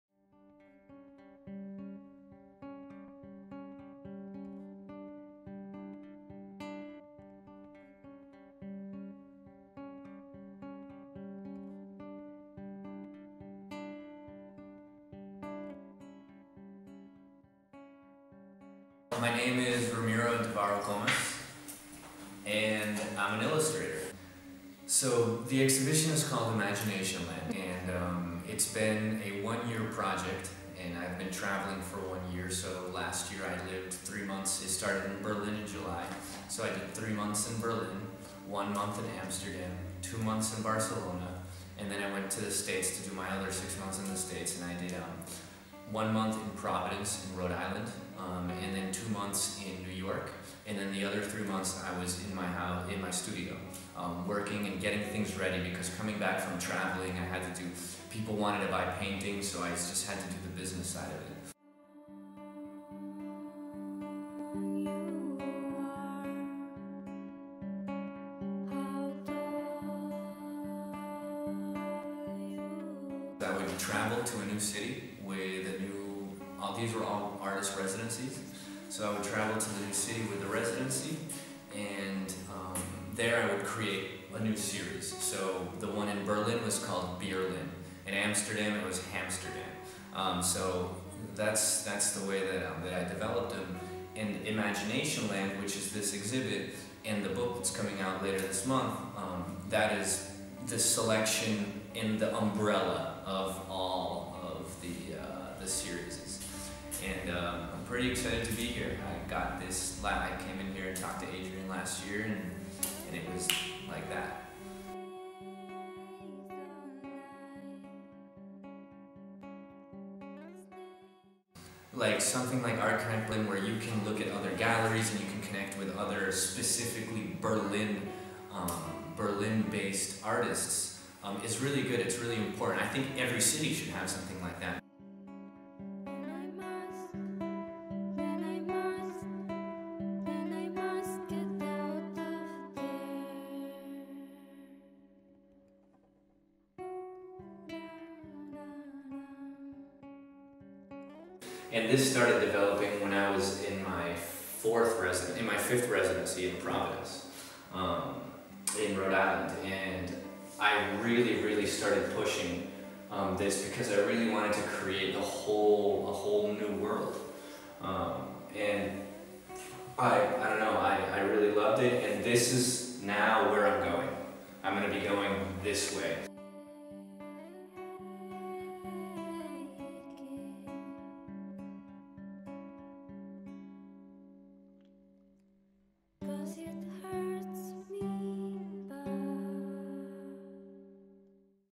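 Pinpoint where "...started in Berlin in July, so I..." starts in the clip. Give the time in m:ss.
0:34.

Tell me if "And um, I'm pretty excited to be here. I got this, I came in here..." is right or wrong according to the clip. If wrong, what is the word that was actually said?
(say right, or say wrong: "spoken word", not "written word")
right.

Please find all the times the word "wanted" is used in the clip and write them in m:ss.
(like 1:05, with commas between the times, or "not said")
0:58, 2:44.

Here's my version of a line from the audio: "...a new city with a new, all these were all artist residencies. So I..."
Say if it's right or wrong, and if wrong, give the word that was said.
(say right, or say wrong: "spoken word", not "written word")
right.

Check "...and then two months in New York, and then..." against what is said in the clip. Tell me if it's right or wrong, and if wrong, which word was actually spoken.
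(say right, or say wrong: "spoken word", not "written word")
right.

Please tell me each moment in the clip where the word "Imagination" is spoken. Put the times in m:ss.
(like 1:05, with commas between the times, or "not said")
0:26, 1:34.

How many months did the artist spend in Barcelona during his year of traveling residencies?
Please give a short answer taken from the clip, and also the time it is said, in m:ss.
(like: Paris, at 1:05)
2, at 0:40.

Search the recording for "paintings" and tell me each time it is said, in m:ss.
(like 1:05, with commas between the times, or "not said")
0:59.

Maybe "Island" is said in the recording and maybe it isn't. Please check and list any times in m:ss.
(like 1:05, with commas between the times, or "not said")
0:47, 2:39.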